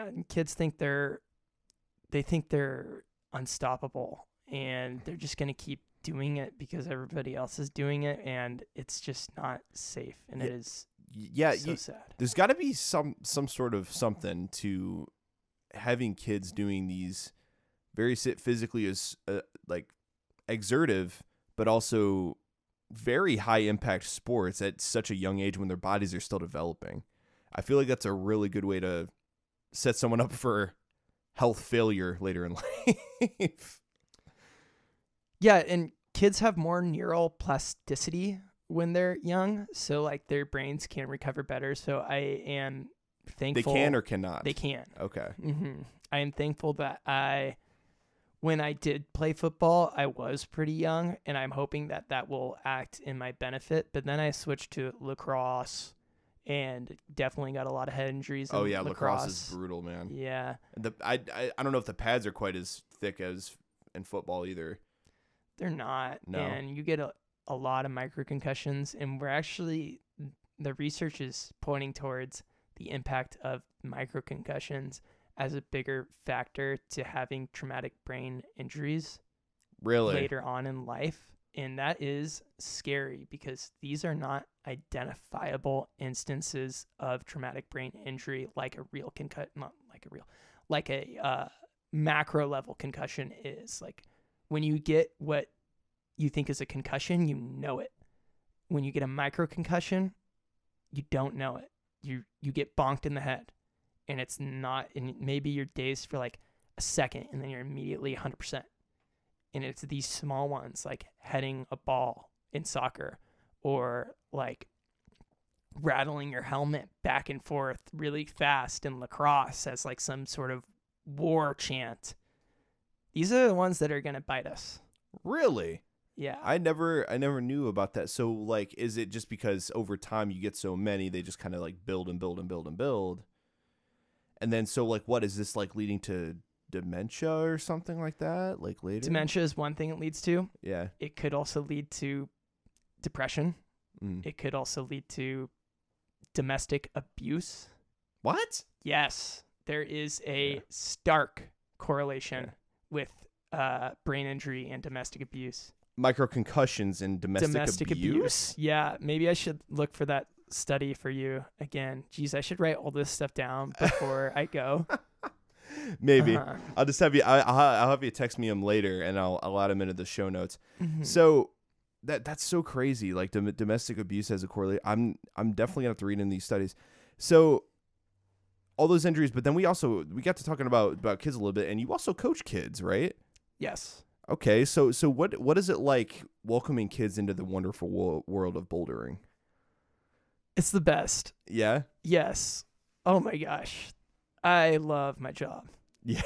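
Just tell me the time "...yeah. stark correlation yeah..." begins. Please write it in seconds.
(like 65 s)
150 s.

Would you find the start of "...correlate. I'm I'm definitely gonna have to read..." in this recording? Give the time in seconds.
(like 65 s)
174 s.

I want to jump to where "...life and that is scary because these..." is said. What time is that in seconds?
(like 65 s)
80 s.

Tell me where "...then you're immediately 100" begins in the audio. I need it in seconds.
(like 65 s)
107 s.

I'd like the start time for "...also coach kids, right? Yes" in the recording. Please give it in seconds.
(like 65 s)
181 s.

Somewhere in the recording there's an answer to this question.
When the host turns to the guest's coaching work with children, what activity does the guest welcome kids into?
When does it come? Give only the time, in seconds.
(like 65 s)
188 s.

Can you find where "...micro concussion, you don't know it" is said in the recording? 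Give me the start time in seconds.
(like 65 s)
99 s.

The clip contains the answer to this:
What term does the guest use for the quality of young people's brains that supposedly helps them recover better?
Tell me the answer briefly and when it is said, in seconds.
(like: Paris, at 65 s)
Neural plasticity, at 36 s.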